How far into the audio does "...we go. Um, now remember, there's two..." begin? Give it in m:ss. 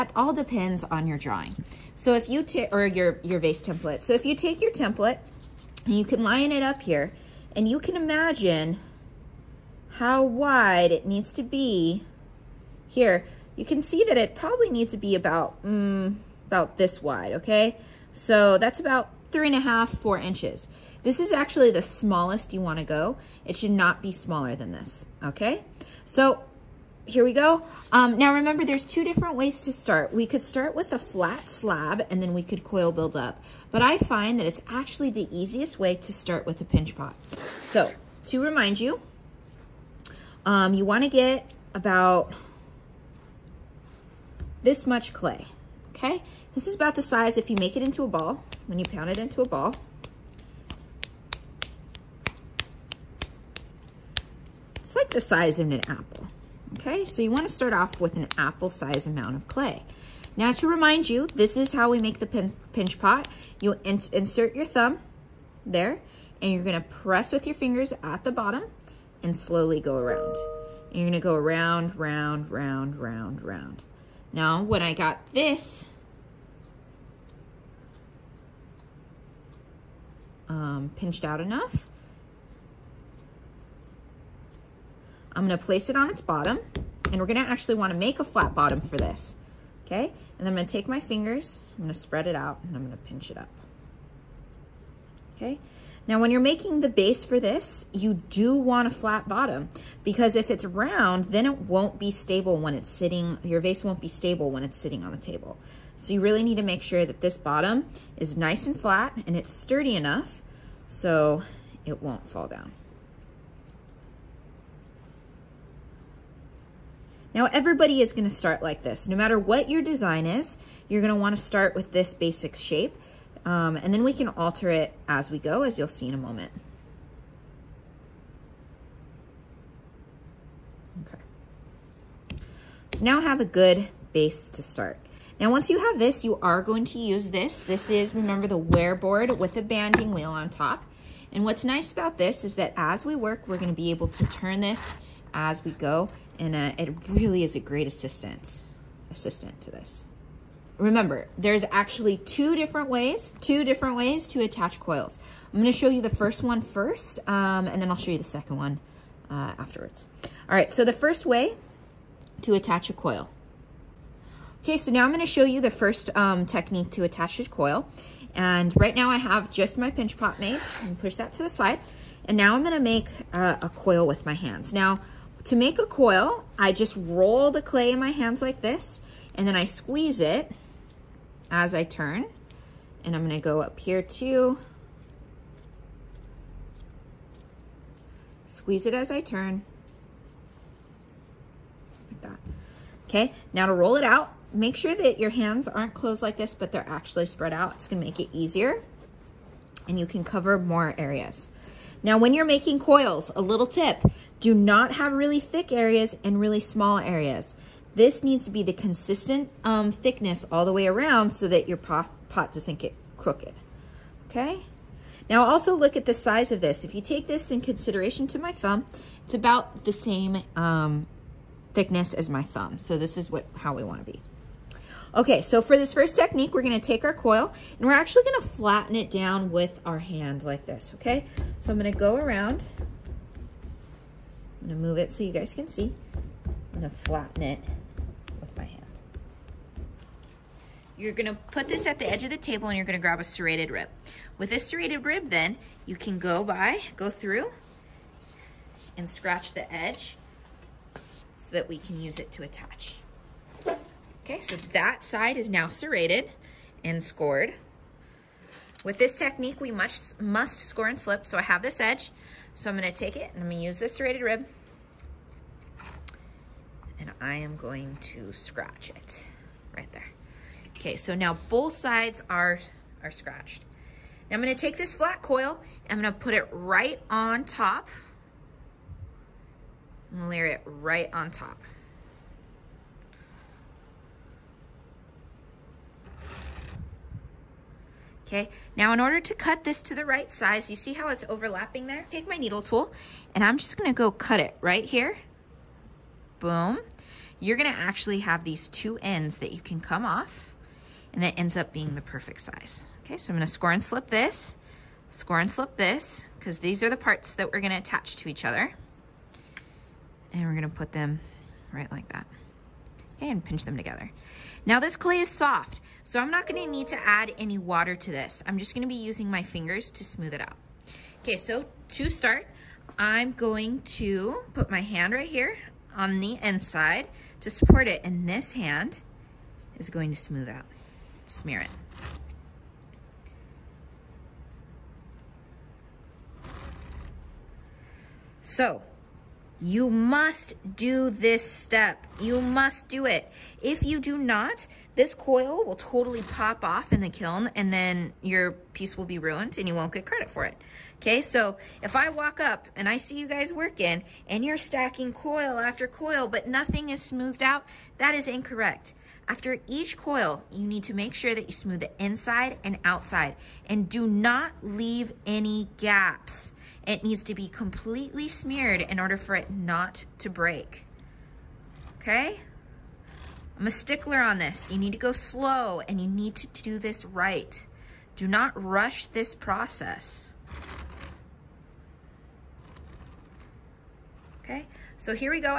0:27.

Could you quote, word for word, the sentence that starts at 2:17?
This is, remember, the ware board with a banding wheel on top.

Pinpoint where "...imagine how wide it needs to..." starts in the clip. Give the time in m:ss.
0:07.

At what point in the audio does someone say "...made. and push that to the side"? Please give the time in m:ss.
2:50.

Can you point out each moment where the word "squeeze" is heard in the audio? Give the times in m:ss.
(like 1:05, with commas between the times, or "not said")
2:59, 3:08.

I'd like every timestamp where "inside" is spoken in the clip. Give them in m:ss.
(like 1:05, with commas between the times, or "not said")
5:26, 6:02.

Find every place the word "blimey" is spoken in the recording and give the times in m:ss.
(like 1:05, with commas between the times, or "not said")
not said.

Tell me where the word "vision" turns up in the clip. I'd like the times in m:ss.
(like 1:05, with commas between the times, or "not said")
not said.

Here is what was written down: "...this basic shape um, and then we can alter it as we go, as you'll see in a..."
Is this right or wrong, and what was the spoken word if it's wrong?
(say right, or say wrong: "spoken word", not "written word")
right.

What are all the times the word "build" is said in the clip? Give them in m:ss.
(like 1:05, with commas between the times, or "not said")
0:32.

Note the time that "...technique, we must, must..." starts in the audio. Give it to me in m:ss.
4:19.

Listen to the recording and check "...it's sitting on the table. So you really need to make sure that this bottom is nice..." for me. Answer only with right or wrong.
right.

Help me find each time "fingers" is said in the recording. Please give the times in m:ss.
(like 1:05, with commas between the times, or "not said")
1:07, 1:30, 5:19.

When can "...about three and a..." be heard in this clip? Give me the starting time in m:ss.
0:18.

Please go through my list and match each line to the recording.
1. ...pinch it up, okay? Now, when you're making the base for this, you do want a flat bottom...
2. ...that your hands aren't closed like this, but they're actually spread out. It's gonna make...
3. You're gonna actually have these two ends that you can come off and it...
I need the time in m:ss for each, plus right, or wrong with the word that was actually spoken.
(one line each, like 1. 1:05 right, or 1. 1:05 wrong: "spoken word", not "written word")
1. 1:32 right
2. 3:14 right
3. 4:57 right.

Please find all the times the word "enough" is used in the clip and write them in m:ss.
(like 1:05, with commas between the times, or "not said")
1:21, 1:49.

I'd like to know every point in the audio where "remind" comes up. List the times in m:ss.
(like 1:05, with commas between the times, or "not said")
0:38, 1:00.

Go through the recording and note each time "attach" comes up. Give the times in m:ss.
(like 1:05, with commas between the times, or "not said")
2:34, 2:42, 2:47, 4:12, 5:07.